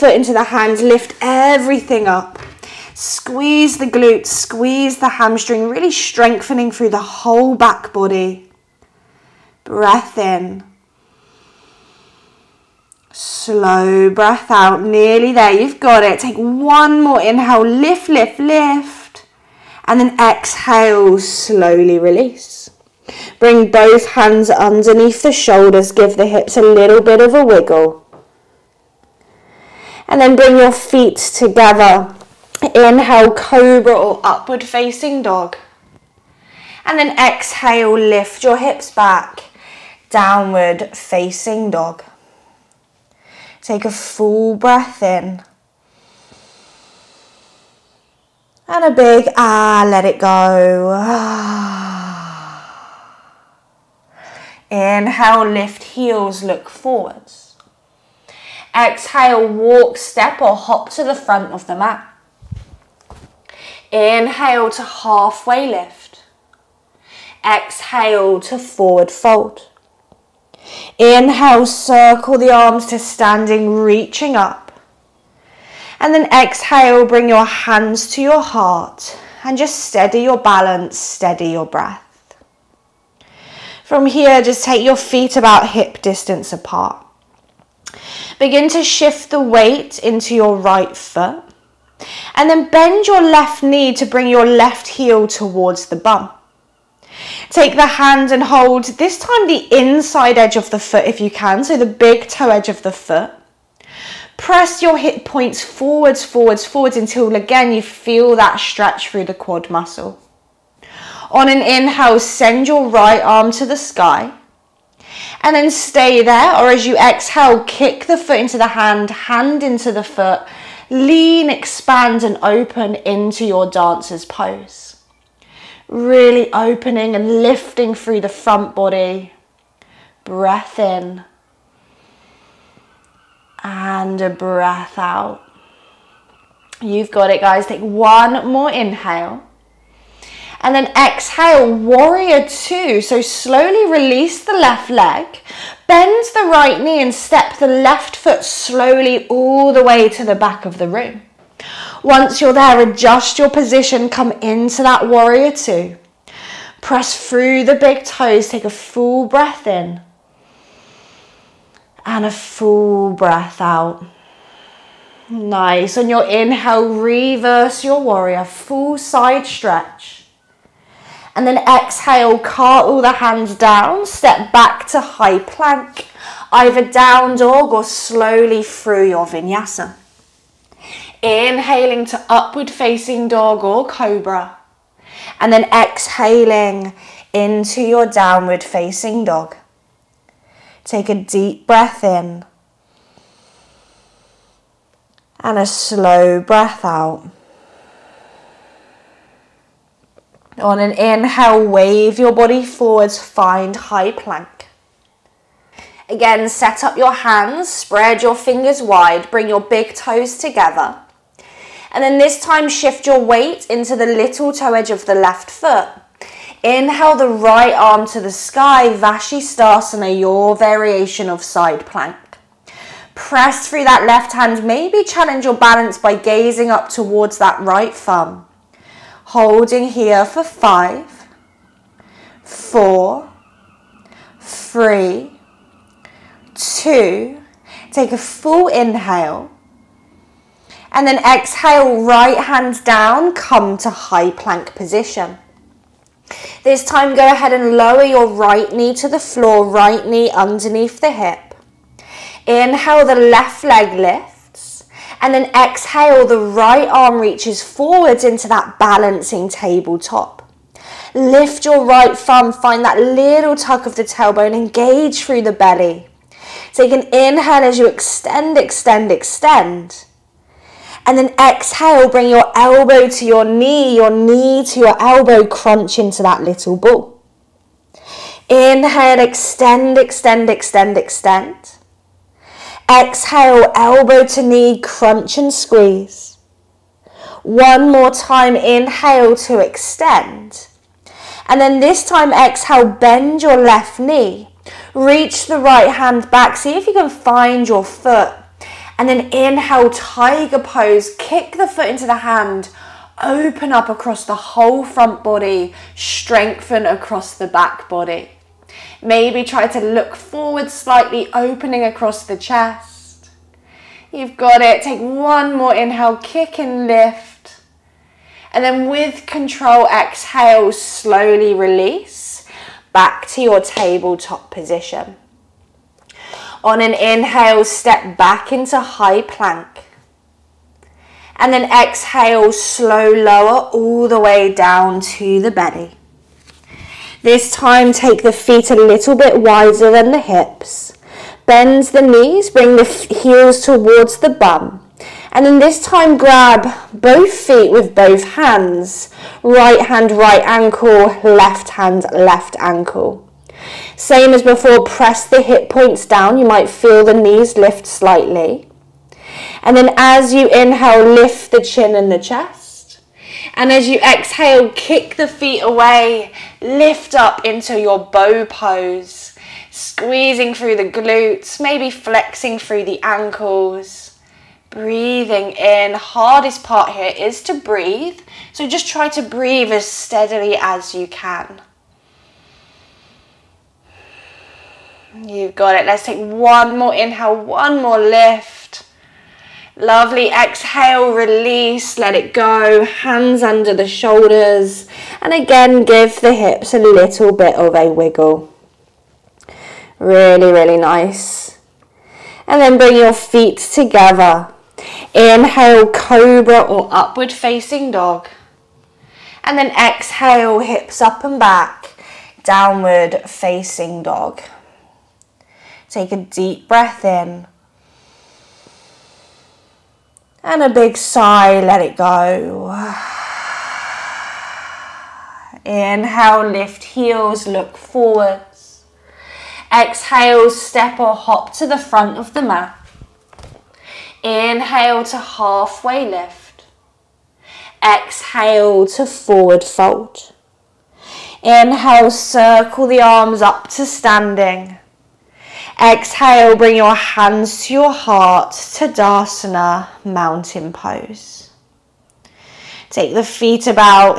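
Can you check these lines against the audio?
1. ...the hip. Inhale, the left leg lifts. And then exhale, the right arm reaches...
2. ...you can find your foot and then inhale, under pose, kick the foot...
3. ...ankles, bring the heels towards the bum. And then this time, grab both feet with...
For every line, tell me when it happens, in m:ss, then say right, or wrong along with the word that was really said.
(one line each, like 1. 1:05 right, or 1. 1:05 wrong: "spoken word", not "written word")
1. 4:10 right
2. 4:56 wrong: "tiger", not "under"
3. 5:42 wrong: "knees", not "ankles".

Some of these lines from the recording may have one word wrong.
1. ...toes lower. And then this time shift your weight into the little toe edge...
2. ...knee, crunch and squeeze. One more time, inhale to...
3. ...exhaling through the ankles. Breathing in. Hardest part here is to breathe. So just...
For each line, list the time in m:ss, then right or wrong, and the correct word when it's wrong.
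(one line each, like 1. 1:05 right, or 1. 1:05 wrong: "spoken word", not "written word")
1. 3:29 wrong: "together", not "lower"
2. 4:44 right
3. 6:11 wrong: "flexing", not "exhaling".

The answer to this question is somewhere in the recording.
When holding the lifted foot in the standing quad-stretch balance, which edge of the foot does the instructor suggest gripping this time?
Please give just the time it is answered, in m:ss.
1:41.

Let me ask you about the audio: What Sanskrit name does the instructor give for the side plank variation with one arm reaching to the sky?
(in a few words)
Vashisthasana.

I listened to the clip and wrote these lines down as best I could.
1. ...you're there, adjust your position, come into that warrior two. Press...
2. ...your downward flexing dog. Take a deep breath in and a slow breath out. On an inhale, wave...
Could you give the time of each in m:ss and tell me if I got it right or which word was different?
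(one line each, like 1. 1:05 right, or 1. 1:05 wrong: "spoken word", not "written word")
1. 2:32 right
2. 3:07 wrong: "facing", not "flexing".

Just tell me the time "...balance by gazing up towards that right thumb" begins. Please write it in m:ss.
3:45.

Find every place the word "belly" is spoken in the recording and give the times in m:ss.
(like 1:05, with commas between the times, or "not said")
4:25, 5:35.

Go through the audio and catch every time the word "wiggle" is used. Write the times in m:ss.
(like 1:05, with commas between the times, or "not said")
0:27, 6:37.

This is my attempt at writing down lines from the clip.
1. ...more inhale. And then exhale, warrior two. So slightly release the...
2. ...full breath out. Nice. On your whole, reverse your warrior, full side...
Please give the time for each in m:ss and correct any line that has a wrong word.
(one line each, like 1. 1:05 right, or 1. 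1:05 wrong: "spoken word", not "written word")
1. 2:18 wrong: "slowly", not "slightly"
2. 2:42 wrong: "inhale", not "whole".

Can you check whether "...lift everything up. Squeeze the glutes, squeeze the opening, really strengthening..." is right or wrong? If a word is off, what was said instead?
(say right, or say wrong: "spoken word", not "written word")
wrong: "hamstring", not "opening".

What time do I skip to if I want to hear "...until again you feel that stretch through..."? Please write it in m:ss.
1:46.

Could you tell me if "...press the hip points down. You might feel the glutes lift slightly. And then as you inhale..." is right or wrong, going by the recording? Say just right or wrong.
wrong.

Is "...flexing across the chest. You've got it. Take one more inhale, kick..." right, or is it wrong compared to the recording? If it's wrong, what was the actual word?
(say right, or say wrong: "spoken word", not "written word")
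wrong: "opening", not "flexing".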